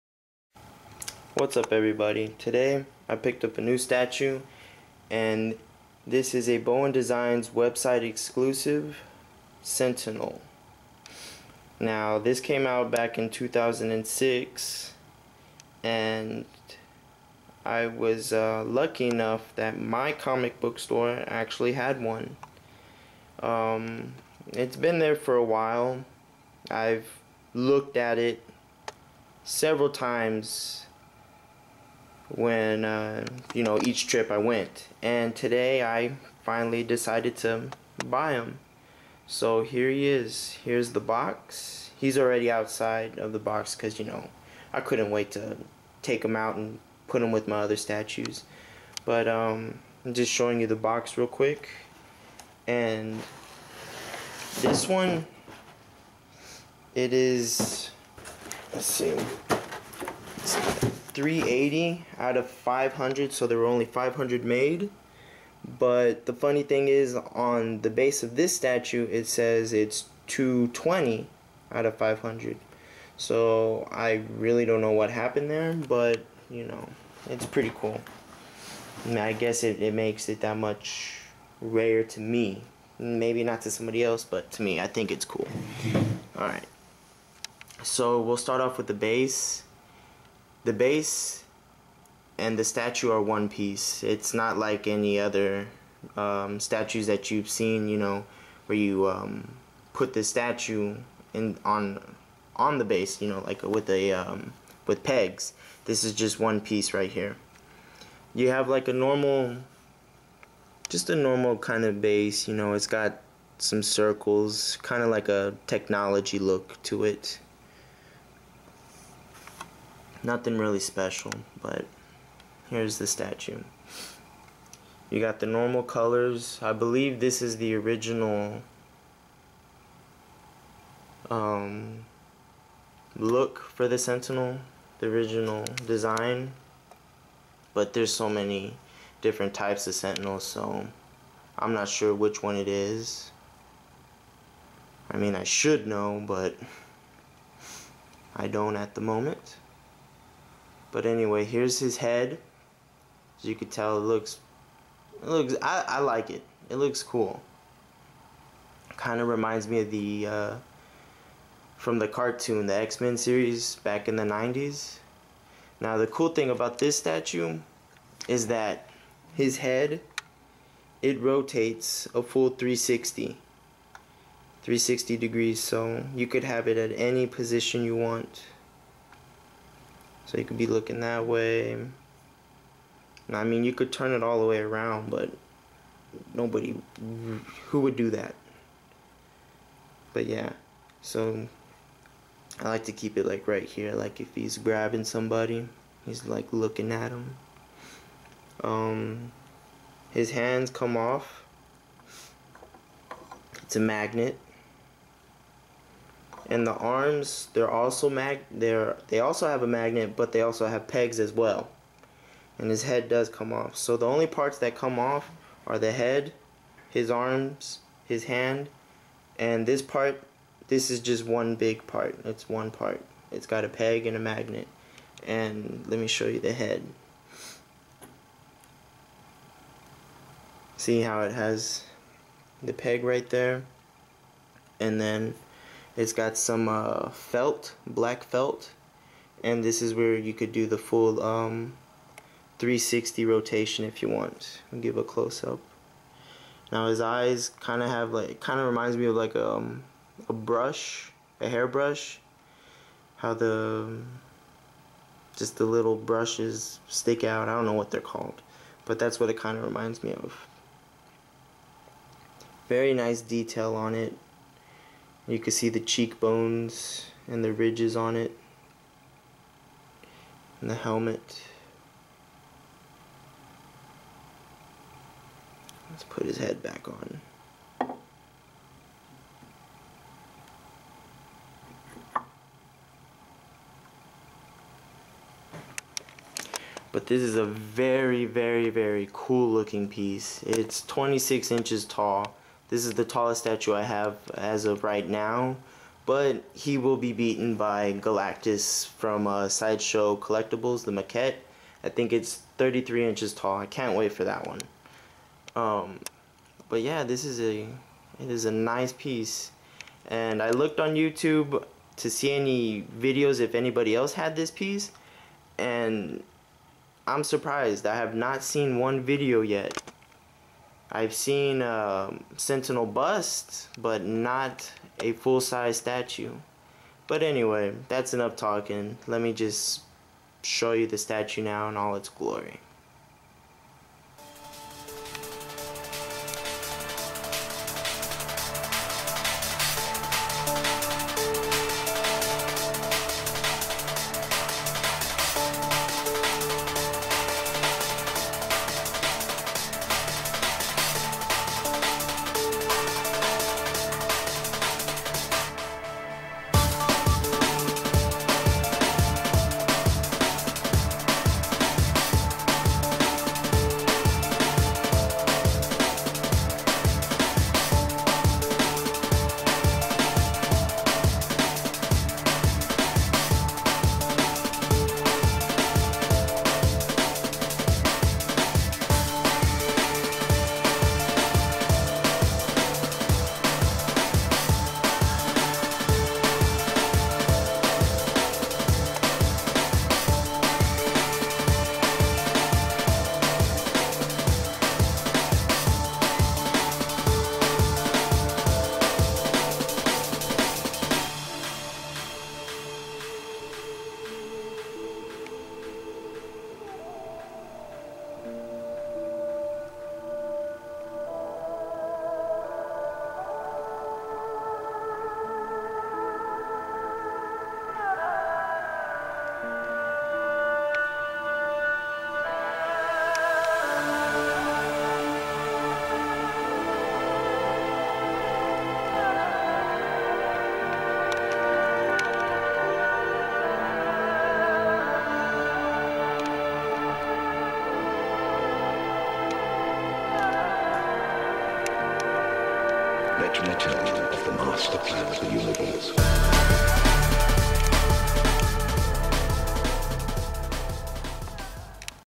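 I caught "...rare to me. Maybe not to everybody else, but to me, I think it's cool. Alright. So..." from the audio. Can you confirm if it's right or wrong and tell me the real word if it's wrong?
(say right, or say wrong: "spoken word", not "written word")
wrong: "somebody", not "everybody".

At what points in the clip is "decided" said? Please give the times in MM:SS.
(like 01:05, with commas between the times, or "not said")
00:36.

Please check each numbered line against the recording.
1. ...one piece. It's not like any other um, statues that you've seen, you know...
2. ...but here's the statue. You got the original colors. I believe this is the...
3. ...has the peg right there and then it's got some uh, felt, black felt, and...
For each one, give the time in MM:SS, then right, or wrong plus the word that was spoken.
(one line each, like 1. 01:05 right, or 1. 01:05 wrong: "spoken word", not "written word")
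1. 01:33 right
2. 02:01 wrong: "normal", not "original"
3. 03:51 right.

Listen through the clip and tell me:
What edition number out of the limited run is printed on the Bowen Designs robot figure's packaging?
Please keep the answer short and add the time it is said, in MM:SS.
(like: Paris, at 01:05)
380, at 01:01.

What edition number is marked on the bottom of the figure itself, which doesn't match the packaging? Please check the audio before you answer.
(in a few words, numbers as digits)
220.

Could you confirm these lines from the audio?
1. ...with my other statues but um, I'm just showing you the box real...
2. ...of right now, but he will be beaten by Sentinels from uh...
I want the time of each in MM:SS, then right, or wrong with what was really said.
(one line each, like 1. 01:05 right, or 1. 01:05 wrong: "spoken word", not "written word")
1. 00:47 right
2. 04:54 wrong: "Galactus", not "Sentinels".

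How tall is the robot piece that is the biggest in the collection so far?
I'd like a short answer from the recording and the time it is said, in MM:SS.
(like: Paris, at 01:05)
26 inches, at 04:50.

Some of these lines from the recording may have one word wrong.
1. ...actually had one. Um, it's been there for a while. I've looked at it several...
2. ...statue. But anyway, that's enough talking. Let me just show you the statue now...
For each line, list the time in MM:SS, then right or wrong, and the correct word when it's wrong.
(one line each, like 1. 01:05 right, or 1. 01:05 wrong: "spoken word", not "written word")
1. 00:21 right
2. 05:25 right.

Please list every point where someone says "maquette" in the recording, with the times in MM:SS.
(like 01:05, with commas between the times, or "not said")
05:00.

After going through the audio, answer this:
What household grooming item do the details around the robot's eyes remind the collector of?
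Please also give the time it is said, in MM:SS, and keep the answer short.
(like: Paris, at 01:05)
a hairbrush, at 04:11.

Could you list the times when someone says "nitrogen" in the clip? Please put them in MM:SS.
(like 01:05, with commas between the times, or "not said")
not said.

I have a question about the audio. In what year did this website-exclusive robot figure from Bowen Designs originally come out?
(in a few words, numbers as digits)
2006.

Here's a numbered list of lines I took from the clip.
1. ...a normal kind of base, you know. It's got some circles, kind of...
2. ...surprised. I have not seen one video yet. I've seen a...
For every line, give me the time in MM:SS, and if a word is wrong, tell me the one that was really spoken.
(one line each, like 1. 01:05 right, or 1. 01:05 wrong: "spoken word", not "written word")
1. 01:51 right
2. 05:17 right.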